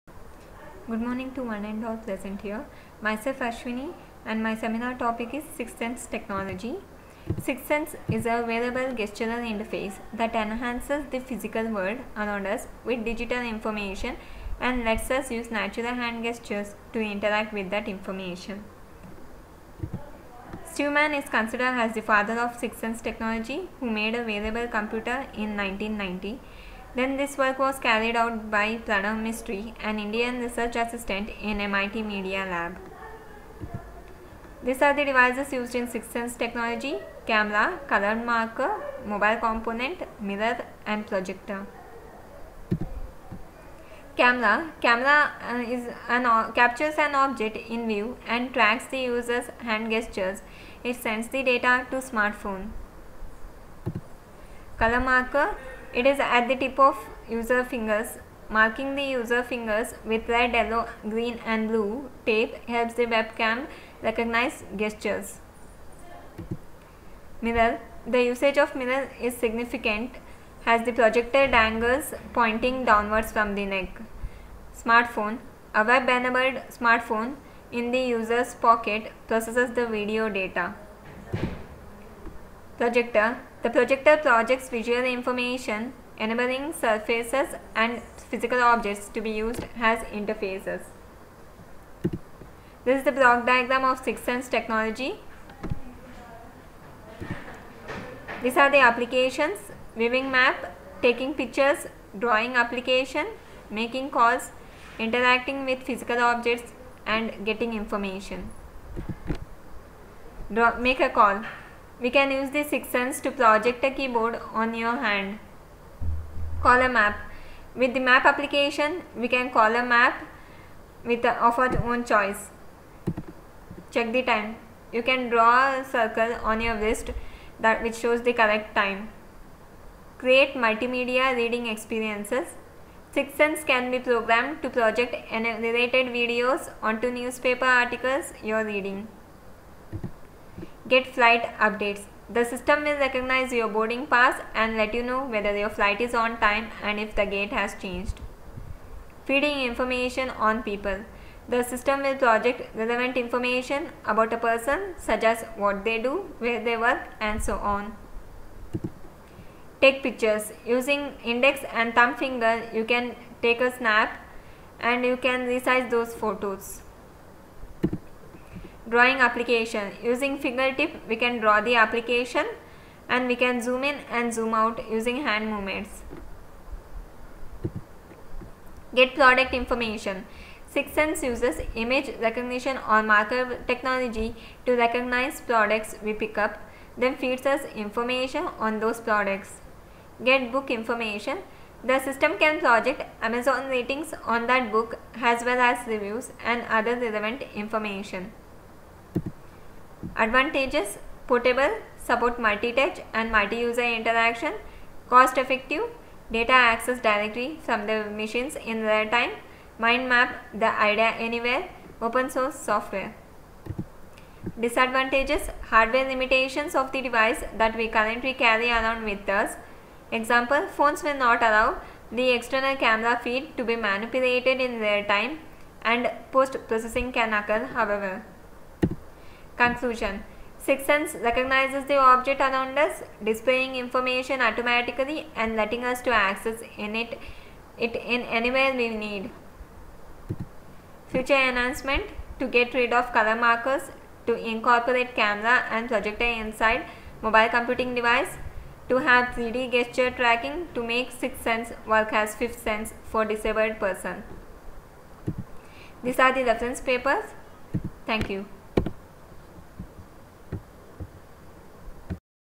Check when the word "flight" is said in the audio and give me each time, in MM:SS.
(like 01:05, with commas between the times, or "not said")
02:21, 02:25.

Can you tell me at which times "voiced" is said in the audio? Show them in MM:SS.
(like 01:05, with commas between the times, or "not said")
not said.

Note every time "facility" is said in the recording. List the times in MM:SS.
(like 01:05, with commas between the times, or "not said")
not said.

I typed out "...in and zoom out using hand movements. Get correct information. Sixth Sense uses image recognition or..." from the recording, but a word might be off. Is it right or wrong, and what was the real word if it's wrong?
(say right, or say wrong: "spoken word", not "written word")
wrong: "product", not "correct".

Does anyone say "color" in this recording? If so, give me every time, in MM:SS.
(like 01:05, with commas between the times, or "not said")
00:37, 00:54, 04:03.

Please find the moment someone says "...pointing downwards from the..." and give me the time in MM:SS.
01:12.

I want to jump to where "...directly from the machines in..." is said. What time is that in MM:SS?
03:26.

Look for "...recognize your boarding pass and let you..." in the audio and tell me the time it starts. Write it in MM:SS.
02:23.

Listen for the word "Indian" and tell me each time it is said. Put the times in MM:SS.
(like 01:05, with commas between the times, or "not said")
00:29.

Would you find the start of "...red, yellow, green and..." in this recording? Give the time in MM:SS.
01:00.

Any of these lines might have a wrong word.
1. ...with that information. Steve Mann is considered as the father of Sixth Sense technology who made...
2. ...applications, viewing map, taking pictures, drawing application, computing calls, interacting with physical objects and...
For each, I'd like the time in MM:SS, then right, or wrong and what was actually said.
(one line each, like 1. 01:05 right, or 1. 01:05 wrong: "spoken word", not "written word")
1. 00:17 right
2. 01:38 wrong: "making", not "computing".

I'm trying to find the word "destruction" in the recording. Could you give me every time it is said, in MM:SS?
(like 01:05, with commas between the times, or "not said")
not said.